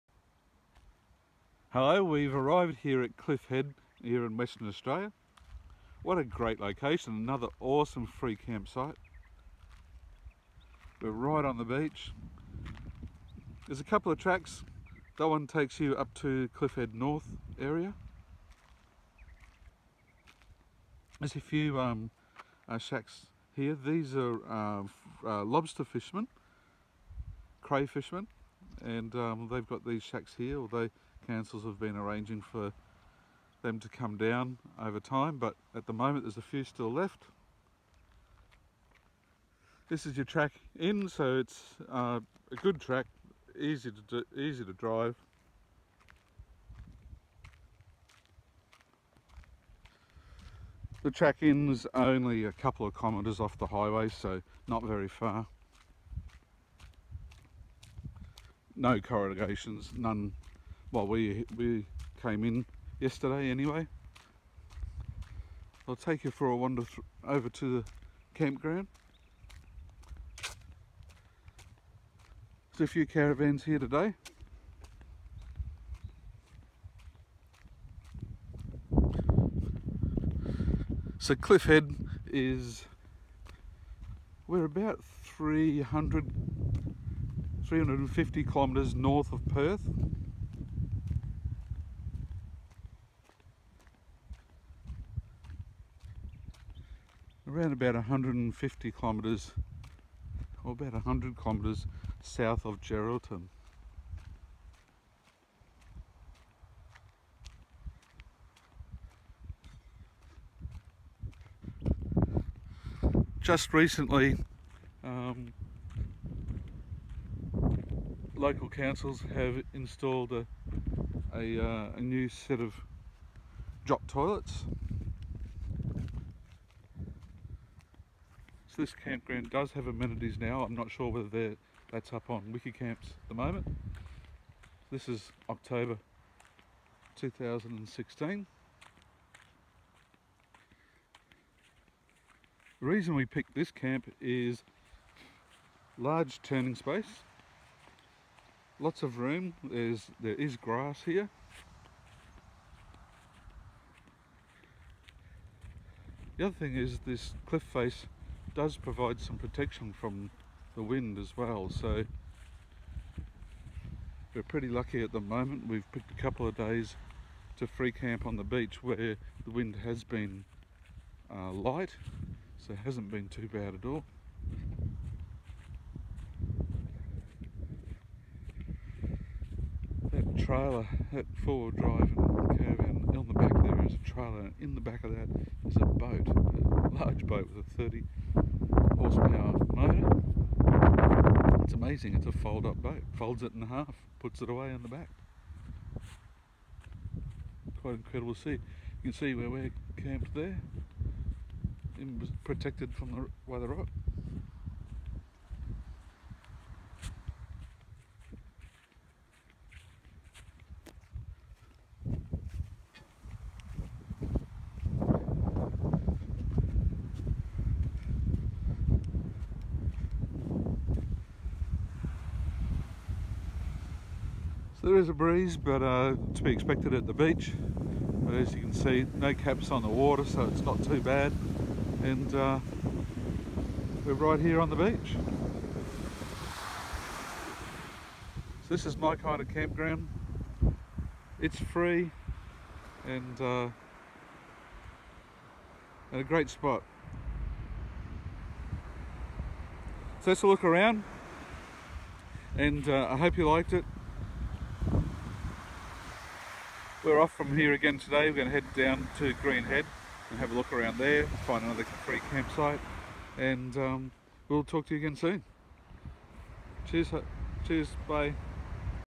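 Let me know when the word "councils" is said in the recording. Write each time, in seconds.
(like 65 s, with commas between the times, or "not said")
31 s, 118 s.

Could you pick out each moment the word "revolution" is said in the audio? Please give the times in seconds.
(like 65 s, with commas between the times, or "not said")
not said.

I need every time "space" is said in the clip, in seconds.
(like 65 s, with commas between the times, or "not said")
146 s.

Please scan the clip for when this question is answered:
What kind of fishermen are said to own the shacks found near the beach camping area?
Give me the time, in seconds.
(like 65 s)
25 s.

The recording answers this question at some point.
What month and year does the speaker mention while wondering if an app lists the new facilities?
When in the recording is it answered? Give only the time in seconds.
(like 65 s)
135 s.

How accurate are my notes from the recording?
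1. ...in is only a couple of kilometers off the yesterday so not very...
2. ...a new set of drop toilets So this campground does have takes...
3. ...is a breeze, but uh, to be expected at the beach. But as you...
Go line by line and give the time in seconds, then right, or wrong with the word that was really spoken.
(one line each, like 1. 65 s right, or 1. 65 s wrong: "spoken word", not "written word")
1. 51 s wrong: "highway", not "yesterday"
2. 121 s wrong: "amenities", not "takes"
3. 224 s right.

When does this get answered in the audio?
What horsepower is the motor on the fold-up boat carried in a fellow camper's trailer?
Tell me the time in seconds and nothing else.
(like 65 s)
187 s.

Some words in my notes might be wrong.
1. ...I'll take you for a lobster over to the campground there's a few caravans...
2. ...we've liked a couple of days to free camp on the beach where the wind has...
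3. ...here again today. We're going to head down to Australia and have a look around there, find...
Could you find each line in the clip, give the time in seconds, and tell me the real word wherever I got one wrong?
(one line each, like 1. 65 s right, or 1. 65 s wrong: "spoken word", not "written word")
1. 65 s wrong: "wander", not "lobster"
2. 165 s wrong: "picked", not "liked"
3. 257 s wrong: "Greenhead", not "Australia".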